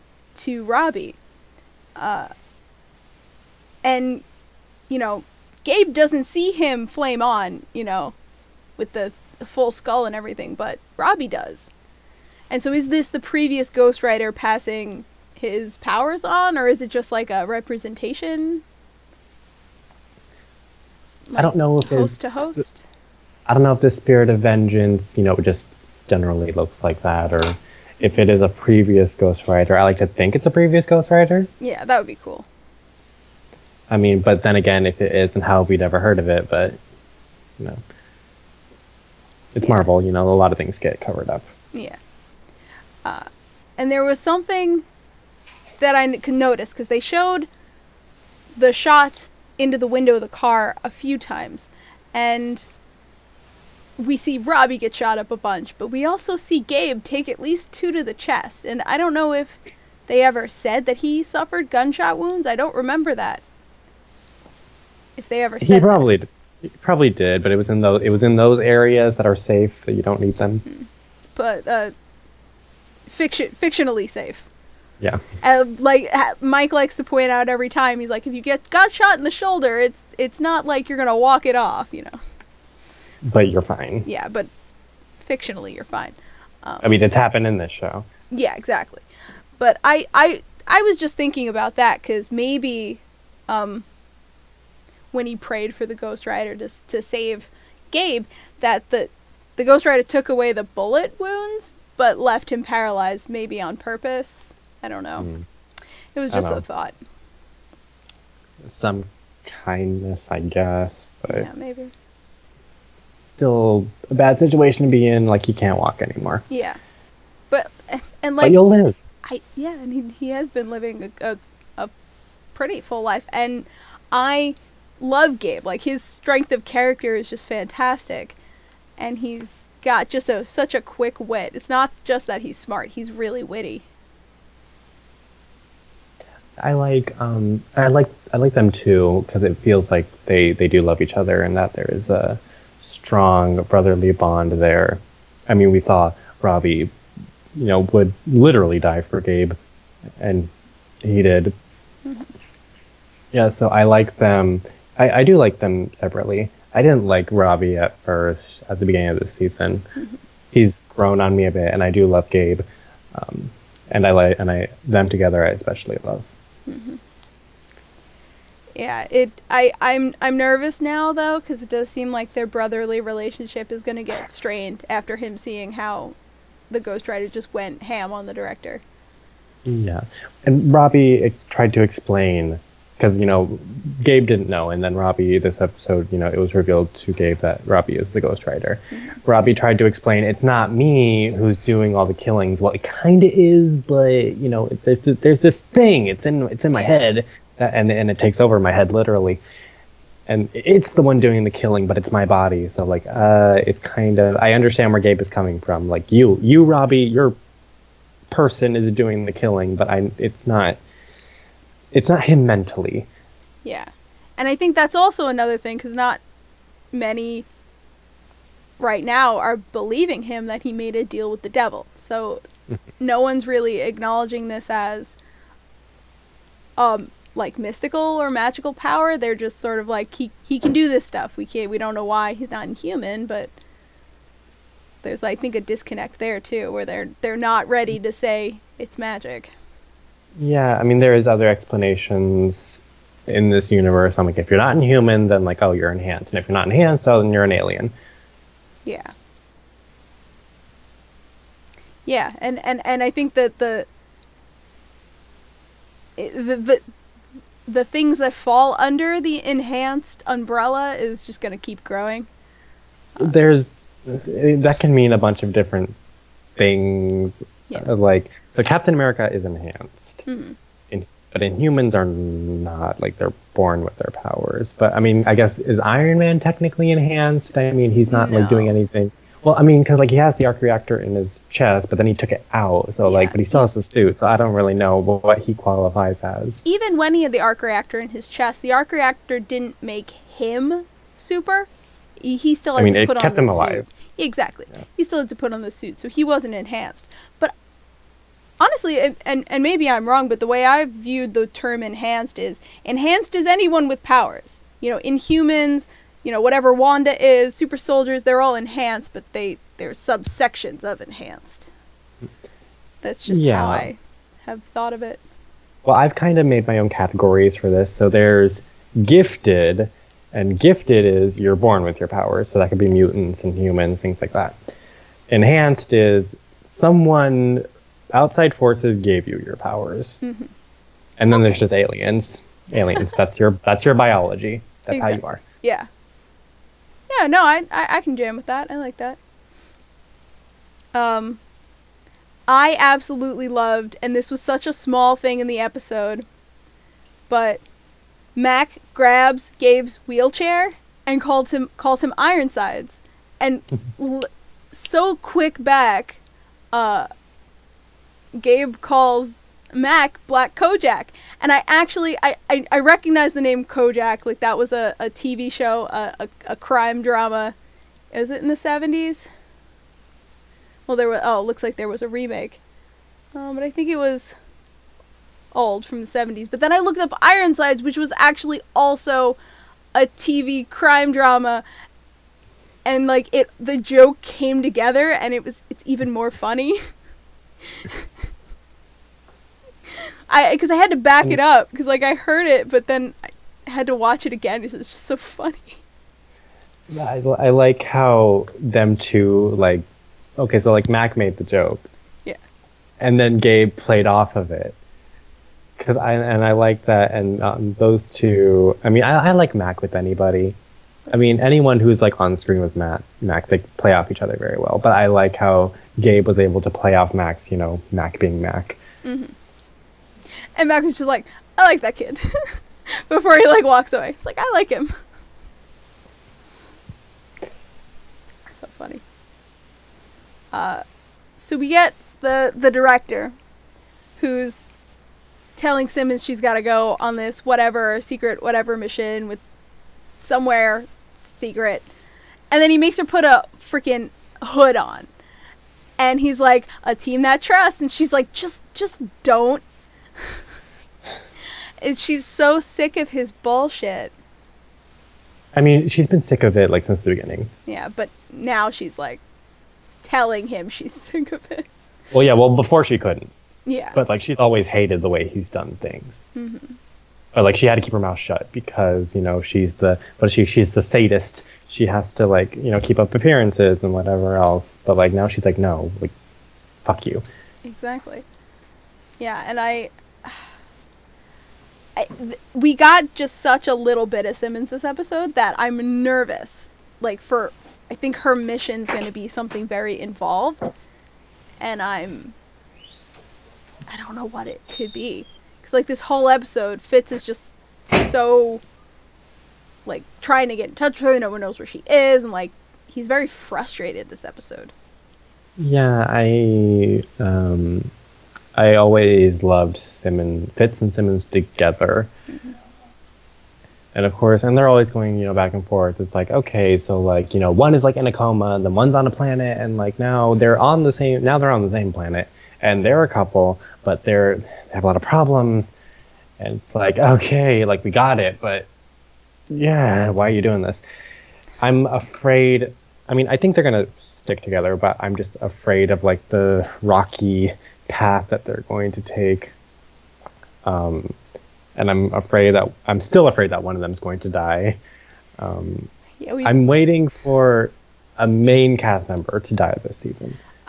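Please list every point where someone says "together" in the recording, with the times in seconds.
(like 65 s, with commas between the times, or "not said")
165 s, 384 s, 511 s, 534 s.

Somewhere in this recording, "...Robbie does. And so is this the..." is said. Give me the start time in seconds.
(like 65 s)
10 s.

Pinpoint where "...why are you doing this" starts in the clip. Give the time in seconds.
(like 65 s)
530 s.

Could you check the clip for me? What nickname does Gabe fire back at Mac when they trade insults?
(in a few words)
Black Kojak.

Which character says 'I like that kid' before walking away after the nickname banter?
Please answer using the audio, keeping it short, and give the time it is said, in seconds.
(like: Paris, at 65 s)
Malcolm, at 420 s.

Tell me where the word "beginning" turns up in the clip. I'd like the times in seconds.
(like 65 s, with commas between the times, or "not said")
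158 s, 457 s.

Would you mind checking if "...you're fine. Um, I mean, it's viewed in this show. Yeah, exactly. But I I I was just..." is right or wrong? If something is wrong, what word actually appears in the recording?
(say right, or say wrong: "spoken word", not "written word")
wrong: "happened", not "viewed".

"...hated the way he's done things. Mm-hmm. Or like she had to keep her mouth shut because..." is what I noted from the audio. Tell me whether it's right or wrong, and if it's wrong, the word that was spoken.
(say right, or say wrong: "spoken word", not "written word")
right.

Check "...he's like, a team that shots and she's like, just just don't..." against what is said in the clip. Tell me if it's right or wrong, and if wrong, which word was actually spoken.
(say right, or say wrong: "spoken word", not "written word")
wrong: "trusts", not "shots".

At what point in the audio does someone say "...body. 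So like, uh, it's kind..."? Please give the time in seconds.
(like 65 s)
202 s.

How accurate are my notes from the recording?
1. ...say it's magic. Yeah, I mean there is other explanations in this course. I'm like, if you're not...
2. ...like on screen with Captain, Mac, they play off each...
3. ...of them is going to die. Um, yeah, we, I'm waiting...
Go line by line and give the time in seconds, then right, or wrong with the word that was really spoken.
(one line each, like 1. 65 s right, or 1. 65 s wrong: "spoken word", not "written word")
1. 238 s wrong: "universe", not "course"
2. 411 s wrong: "Matt", not "Captain"
3. 543 s right.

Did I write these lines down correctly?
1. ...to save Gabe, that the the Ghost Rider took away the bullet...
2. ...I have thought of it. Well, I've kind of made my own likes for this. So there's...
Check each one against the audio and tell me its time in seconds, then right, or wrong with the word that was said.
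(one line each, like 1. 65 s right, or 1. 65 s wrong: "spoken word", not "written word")
1. 96 s right
2. 313 s wrong: "categories", not "likes".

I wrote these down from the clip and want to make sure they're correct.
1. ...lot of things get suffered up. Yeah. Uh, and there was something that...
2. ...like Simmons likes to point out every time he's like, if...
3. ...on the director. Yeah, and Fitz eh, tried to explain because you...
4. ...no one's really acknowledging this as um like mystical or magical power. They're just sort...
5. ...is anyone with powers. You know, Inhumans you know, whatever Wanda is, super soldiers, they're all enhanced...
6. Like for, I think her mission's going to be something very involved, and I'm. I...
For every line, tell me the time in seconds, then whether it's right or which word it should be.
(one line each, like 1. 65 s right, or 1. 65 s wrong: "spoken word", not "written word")
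1. 40 s wrong: "covered", not "suffered"
2. 75 s wrong: "Mike", not "Simmons"
3. 178 s wrong: "Robbie", not "Fitz"
4. 222 s right
5. 303 s right
6. 486 s right.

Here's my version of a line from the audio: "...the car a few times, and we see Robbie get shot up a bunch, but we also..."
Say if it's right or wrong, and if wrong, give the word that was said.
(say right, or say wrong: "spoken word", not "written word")
right.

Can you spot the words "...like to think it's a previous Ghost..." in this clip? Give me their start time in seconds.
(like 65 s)
29 s.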